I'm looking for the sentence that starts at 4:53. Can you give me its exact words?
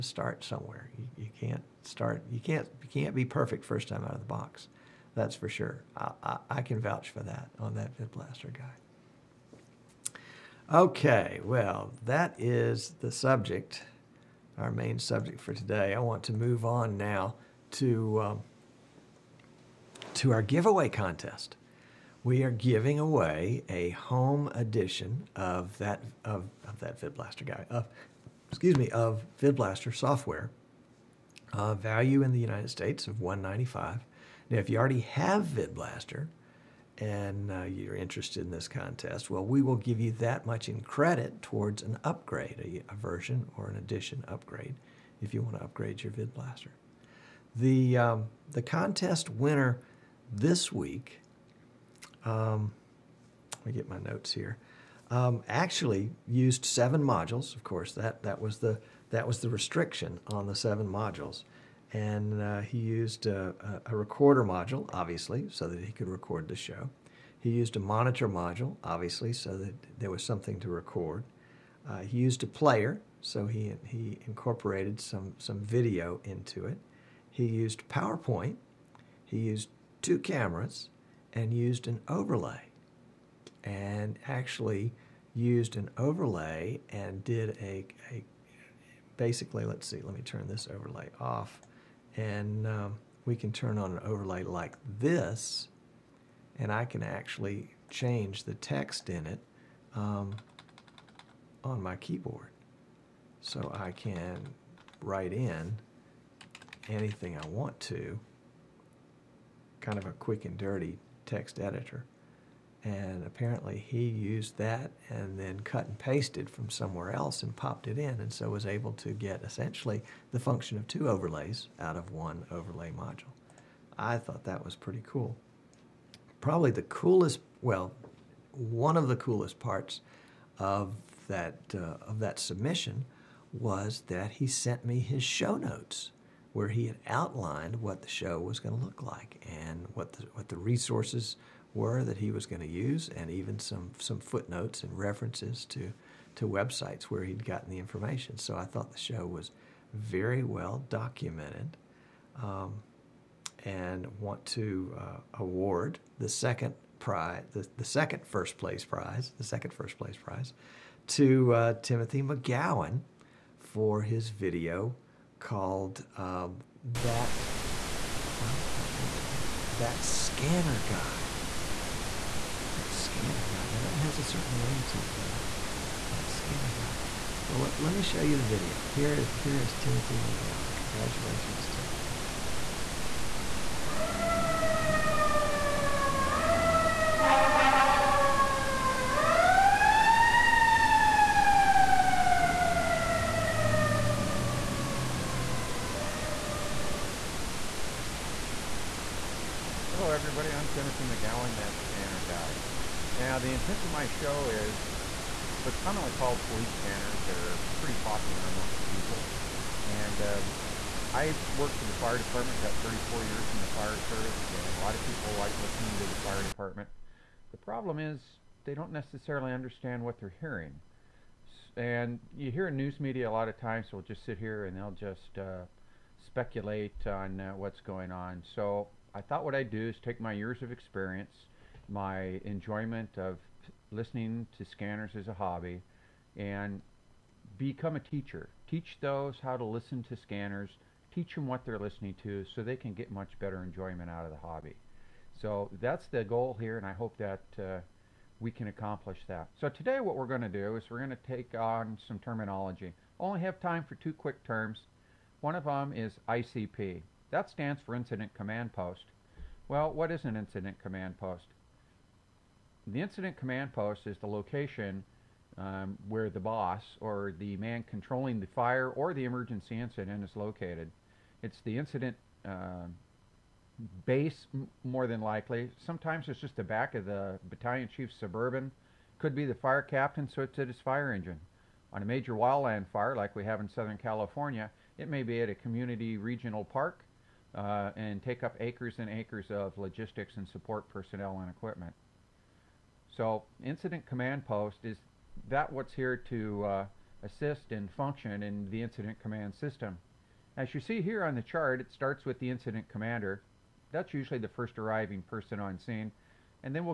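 So incident command post is that what's here to uh, assist and function in the incident command system.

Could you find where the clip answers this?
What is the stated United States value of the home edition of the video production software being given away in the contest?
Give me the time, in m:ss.
0:33.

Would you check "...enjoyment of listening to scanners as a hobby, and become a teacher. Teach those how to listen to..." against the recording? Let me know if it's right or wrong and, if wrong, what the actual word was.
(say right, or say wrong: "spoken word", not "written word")
right.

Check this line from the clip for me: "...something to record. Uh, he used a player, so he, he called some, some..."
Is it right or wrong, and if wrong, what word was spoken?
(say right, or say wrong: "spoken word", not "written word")
wrong: "incorporated", not "called".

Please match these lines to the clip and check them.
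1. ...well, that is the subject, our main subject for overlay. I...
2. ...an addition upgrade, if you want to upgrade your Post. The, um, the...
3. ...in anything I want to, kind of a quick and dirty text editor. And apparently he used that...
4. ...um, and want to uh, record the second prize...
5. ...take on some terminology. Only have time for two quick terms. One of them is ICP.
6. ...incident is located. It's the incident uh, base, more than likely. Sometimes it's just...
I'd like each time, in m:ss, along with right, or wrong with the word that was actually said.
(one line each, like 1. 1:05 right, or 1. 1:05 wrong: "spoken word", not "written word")
1. 0:11 wrong: "today", not "overlay"
2. 0:43 wrong: "VidBlaster", not "Post"
3. 1:45 right
4. 2:32 wrong: "award", not "record"
5. 4:11 right
6. 4:29 right.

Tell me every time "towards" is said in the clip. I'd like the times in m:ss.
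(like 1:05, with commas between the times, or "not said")
0:41.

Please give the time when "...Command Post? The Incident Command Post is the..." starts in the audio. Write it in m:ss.
4:20.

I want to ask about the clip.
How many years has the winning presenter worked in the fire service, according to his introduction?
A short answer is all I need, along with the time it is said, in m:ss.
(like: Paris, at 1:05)
34, at 3:32.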